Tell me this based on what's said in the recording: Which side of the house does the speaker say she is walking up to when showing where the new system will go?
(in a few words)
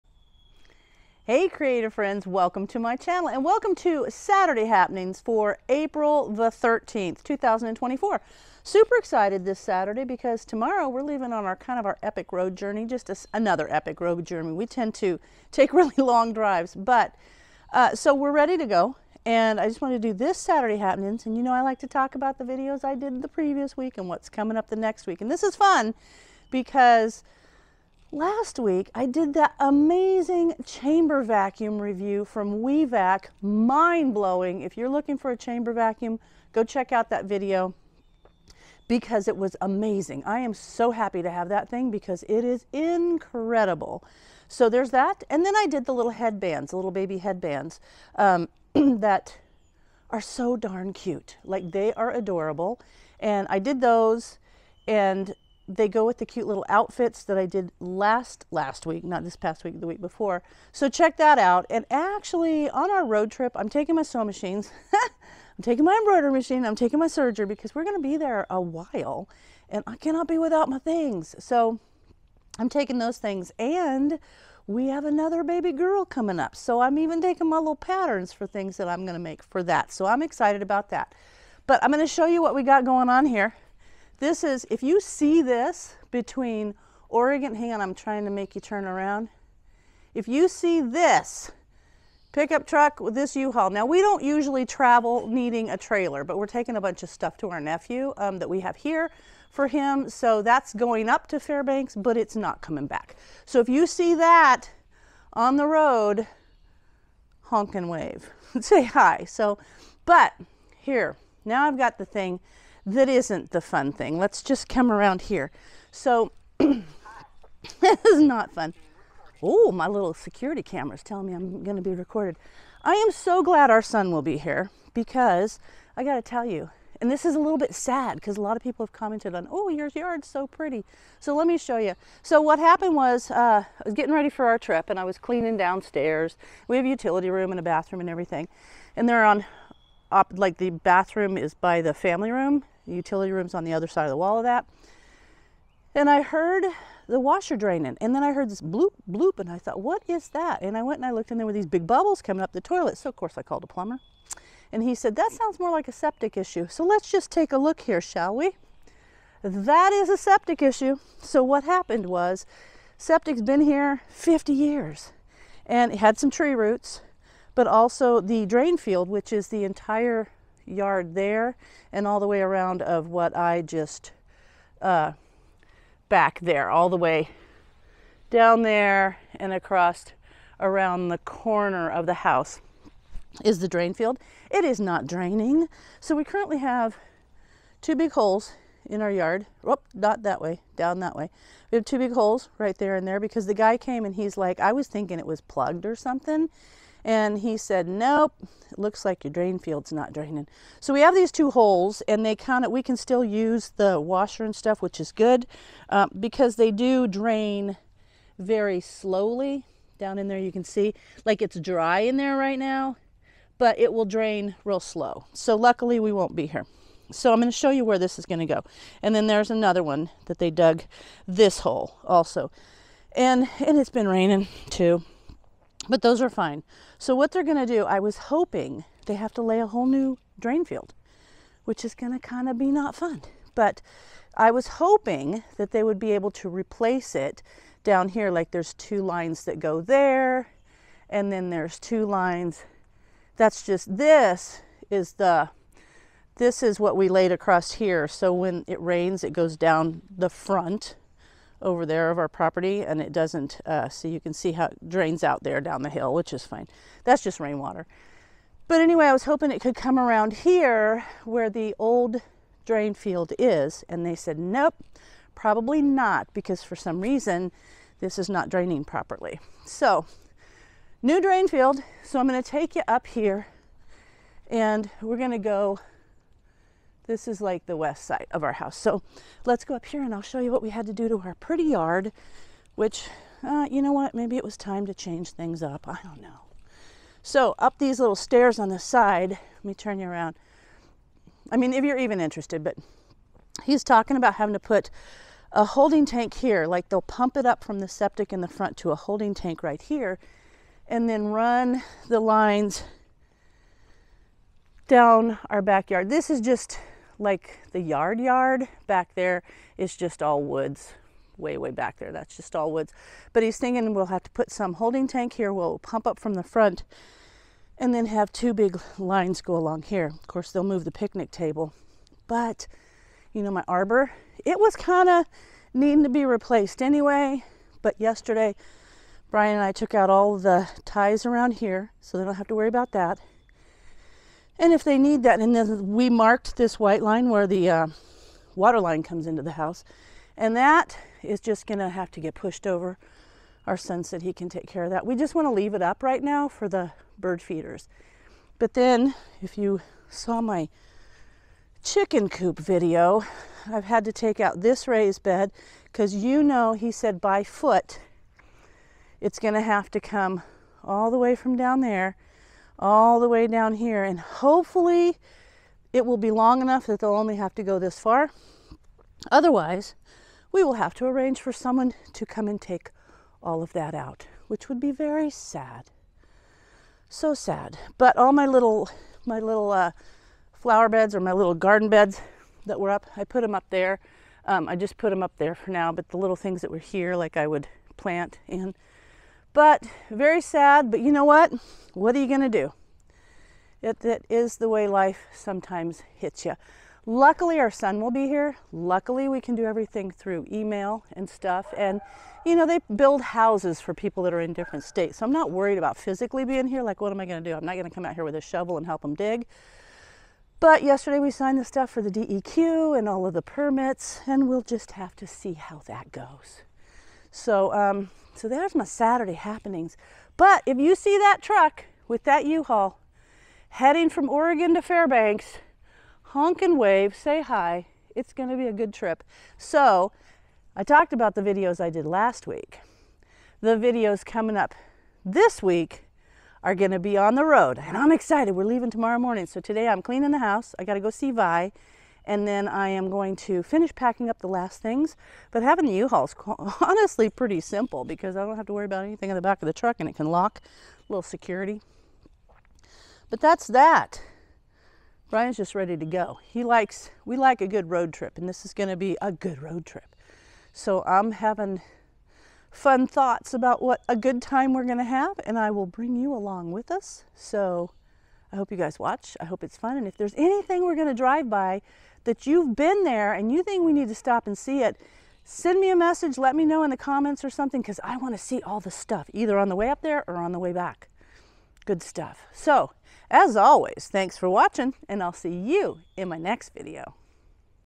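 west side.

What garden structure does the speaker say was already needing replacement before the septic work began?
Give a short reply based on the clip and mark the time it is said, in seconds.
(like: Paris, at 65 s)
arbor, at 323 s.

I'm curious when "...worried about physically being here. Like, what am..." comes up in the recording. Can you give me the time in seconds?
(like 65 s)
405 s.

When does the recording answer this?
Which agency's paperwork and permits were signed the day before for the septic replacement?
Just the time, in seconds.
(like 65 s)
412 s.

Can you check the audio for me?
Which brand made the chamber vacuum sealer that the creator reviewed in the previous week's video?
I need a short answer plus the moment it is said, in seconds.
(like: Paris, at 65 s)
WeVac, at 32 s.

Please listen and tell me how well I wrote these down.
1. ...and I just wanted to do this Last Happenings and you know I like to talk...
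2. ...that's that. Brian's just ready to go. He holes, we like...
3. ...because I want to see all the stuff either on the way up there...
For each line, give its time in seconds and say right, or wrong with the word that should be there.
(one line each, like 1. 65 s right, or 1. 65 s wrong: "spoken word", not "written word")
1. 19 s wrong: "Saturday", not "Last"
2. 453 s wrong: "likes", not "holes"
3. 477 s right.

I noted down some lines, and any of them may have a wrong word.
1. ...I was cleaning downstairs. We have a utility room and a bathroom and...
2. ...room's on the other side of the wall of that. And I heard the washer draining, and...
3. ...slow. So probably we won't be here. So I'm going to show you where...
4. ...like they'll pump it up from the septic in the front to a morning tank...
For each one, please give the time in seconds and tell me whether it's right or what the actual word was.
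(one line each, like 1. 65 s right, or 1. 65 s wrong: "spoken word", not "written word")
1. 134 s right
2. 143 s right
3. 214 s wrong: "luckily", not "probably"
4. 296 s wrong: "holding", not "morning".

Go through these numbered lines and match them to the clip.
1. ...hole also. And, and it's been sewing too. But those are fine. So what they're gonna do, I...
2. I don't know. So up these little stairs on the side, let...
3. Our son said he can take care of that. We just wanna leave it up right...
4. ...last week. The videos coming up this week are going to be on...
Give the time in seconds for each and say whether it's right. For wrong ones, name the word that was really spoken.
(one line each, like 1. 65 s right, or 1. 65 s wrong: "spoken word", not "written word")
1. 221 s wrong: "raining", not "sewing"
2. 285 s right
3. 343 s right
4. 432 s right.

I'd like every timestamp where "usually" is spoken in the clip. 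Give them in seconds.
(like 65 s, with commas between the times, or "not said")
94 s.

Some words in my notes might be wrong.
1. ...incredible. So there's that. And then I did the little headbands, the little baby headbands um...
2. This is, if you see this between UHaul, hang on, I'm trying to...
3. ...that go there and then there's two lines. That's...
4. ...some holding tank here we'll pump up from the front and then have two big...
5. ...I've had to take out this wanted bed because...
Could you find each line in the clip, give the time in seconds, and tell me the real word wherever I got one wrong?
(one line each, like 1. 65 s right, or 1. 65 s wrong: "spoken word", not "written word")
1. 42 s right
2. 84 s wrong: "Oregon", not "UHaul"
3. 239 s right
4. 314 s right
5. 353 s wrong: "raised", not "wanted".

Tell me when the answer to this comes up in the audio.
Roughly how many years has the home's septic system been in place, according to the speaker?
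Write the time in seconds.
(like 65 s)
164 s.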